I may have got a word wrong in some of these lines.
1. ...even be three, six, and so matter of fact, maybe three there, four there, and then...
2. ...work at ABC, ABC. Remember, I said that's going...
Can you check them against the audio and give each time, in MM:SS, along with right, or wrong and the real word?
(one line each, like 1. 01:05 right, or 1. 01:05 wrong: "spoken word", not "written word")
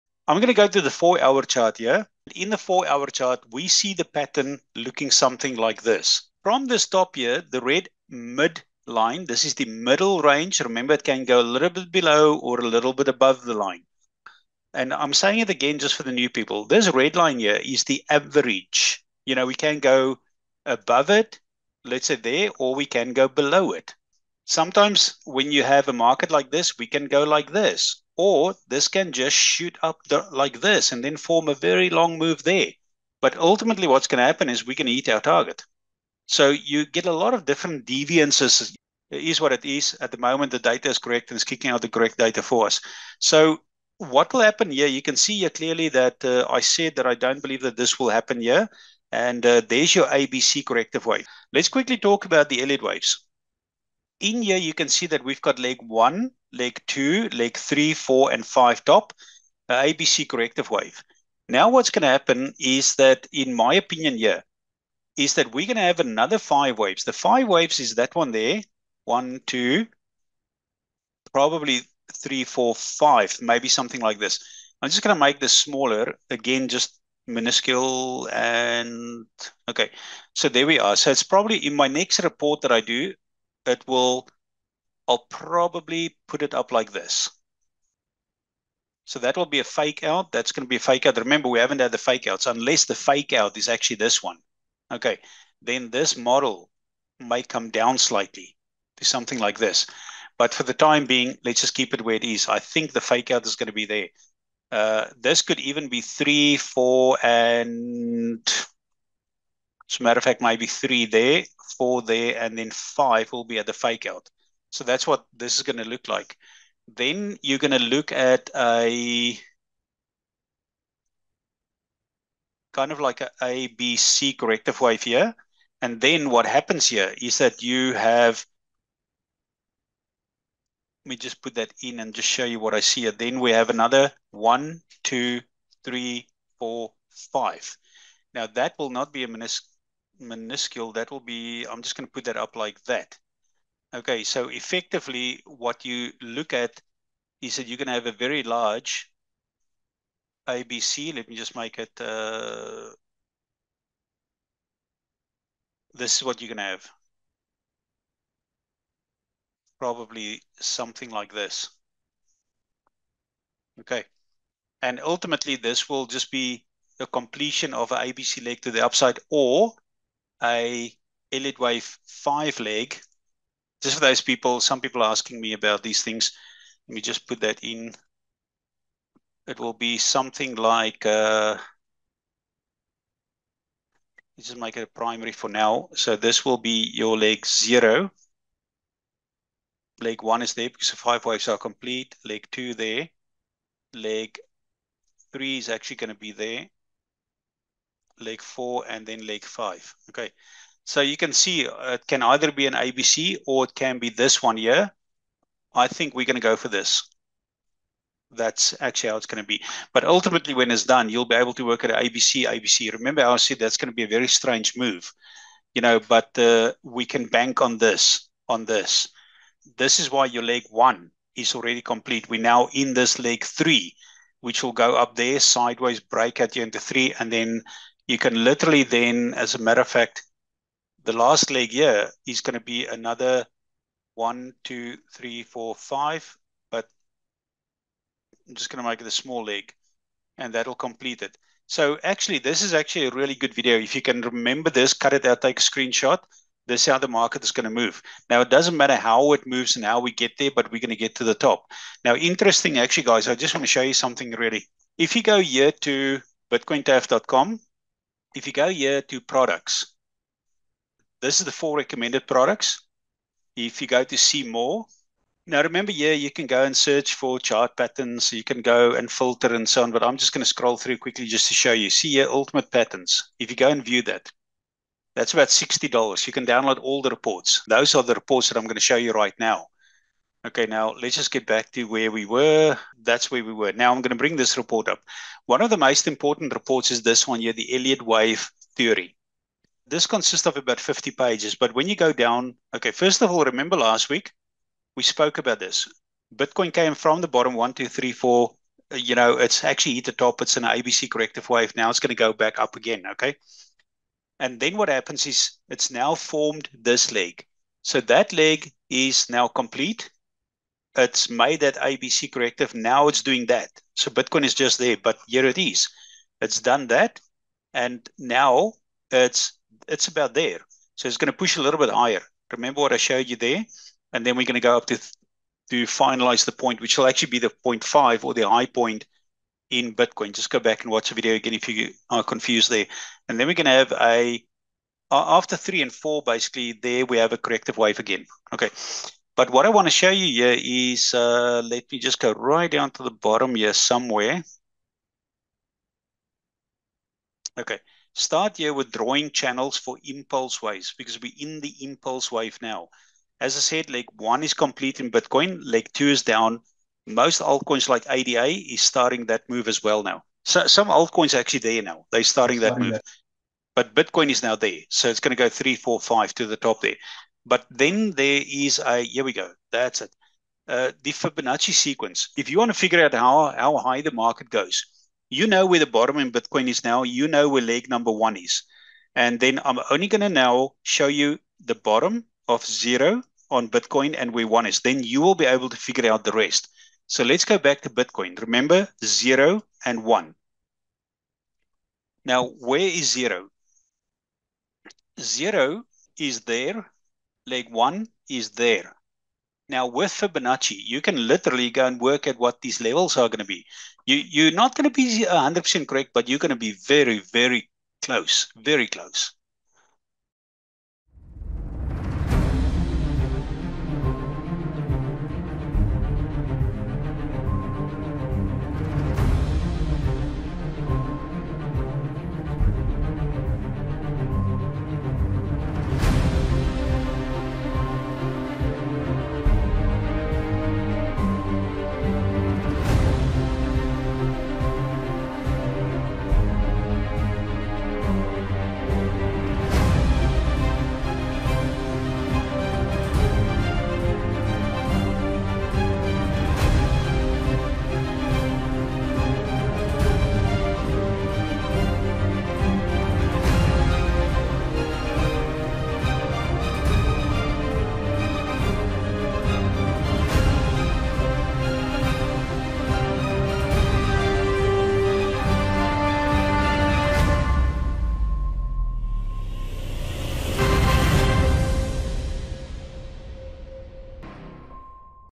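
1. 01:45 wrong: "four", not "six"
2. 03:31 right.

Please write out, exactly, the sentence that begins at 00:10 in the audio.
Remember, it can go a little bit below or a little bit above the line.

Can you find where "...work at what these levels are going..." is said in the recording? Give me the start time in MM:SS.
06:41.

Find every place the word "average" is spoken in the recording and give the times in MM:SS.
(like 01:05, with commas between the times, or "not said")
00:18.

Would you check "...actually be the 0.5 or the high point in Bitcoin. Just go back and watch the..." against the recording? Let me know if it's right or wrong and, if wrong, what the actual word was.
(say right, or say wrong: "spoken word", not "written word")
right.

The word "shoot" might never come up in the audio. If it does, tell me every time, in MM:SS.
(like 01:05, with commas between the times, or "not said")
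00:29.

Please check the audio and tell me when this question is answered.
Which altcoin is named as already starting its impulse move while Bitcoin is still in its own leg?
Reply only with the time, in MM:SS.
05:58.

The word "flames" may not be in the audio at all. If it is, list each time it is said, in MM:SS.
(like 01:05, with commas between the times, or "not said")
not said.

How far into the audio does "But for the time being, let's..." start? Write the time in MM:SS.
01:40.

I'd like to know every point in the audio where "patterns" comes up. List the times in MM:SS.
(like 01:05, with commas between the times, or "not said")
00:04, 04:27, 04:32.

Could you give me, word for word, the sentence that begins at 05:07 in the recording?
So that leg is now complete it's made that ABC corrective.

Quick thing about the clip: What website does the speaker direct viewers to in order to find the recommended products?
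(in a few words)
bitcointaf.com.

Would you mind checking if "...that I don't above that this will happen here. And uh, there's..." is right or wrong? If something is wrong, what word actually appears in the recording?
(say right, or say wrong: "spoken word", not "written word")
wrong: "believe", not "above".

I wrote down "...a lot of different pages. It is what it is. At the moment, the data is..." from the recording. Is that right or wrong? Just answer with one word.
wrong.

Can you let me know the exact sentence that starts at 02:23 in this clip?
Okay, so effectively what you look at is that you're going to have a very large ABC.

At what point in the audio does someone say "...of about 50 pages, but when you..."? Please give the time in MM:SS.
04:50.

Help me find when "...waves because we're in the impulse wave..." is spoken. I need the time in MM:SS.
05:50.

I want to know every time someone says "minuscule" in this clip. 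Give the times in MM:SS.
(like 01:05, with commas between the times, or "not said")
01:17, 02:20.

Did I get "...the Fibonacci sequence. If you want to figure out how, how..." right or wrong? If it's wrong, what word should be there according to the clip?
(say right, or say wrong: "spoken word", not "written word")
right.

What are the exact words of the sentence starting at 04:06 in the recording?
This is how the market is going to move.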